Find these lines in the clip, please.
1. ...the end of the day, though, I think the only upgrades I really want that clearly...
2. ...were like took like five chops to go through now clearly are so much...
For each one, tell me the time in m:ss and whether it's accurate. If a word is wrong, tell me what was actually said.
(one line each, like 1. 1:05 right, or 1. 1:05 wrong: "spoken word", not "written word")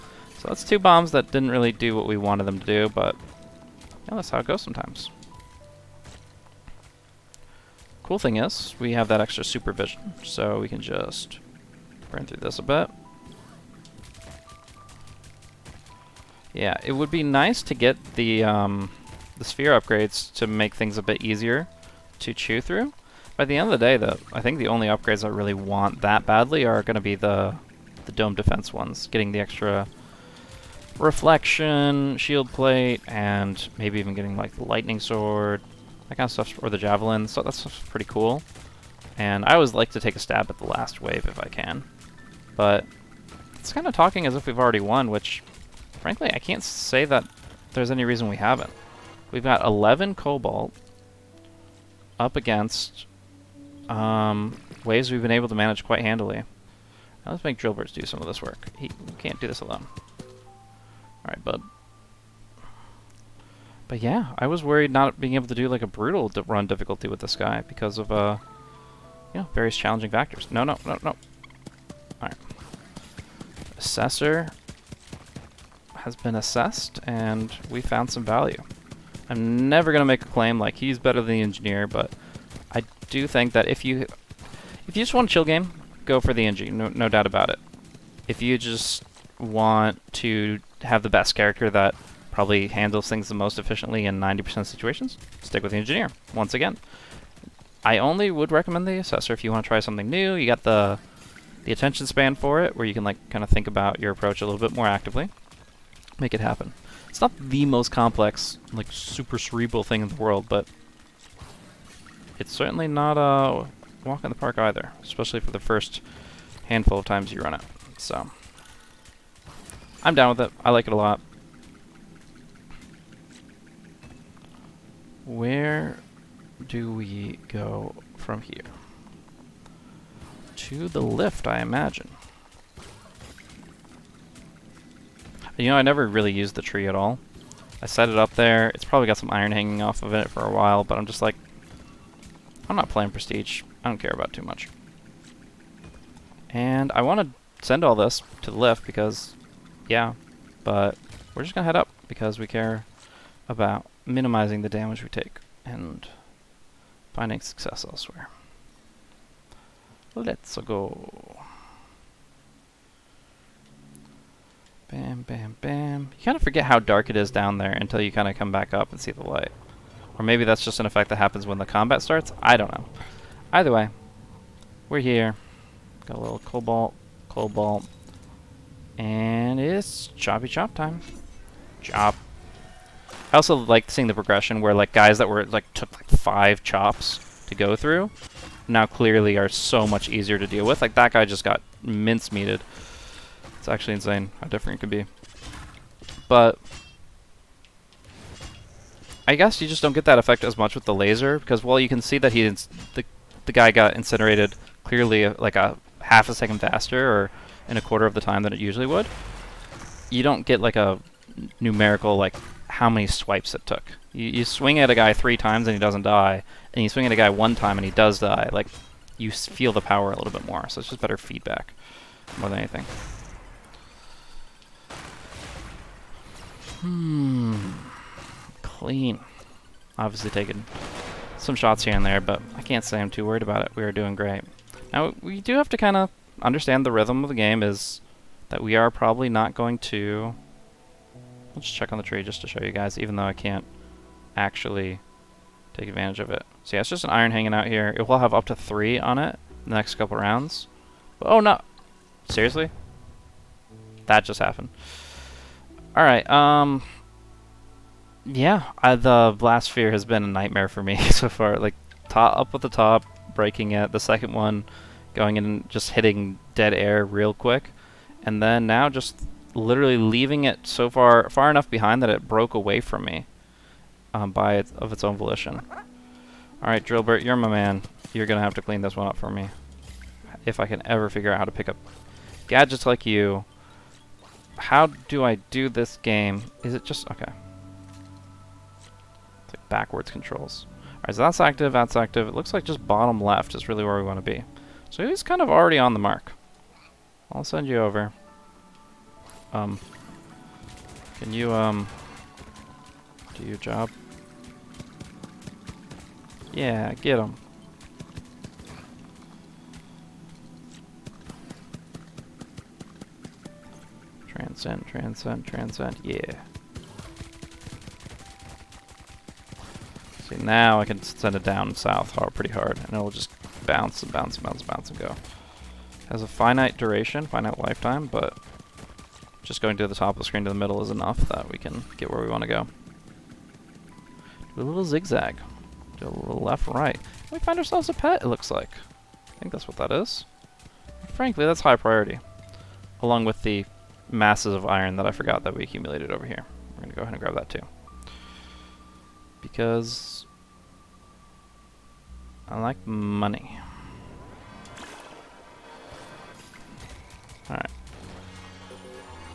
1. 0:23 wrong: "badly", not "clearly"
2. 3:05 right.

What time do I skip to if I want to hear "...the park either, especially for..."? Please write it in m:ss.
1:54.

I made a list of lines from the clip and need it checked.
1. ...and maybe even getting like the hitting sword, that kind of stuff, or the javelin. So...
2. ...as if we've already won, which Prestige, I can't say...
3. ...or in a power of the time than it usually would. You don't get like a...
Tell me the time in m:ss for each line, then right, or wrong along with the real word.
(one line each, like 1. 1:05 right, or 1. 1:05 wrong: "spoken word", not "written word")
1. 0:33 wrong: "lightning", not "hitting"
2. 0:44 wrong: "Frankly", not "Prestige"
3. 3:27 wrong: "quarter", not "power".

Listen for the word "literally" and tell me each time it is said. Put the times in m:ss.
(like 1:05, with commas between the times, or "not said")
4:29.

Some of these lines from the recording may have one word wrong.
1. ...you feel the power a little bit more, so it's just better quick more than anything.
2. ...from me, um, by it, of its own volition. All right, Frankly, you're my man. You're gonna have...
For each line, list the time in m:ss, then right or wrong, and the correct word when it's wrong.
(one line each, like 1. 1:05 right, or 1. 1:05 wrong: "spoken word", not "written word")
1. 3:39 wrong: "feedback", not "quick"
2. 4:32 wrong: "Drillbert", not "Frankly".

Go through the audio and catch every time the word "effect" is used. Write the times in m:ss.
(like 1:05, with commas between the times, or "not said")
2:50, 3:20.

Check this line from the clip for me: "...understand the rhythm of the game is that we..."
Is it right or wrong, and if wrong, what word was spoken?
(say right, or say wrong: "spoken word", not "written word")
right.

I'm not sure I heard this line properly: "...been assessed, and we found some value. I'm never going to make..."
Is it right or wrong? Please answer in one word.
right.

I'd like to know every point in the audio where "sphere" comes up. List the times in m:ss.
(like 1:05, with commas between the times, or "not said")
0:19, 4:19.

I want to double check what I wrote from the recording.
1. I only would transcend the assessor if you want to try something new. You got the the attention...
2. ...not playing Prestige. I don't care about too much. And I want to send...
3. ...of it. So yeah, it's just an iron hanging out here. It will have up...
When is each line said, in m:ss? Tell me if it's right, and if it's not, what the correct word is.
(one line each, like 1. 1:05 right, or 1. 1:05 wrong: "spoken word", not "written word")
1. 1:37 wrong: "recommend", not "transcend"
2. 2:22 right
3. 4:06 right.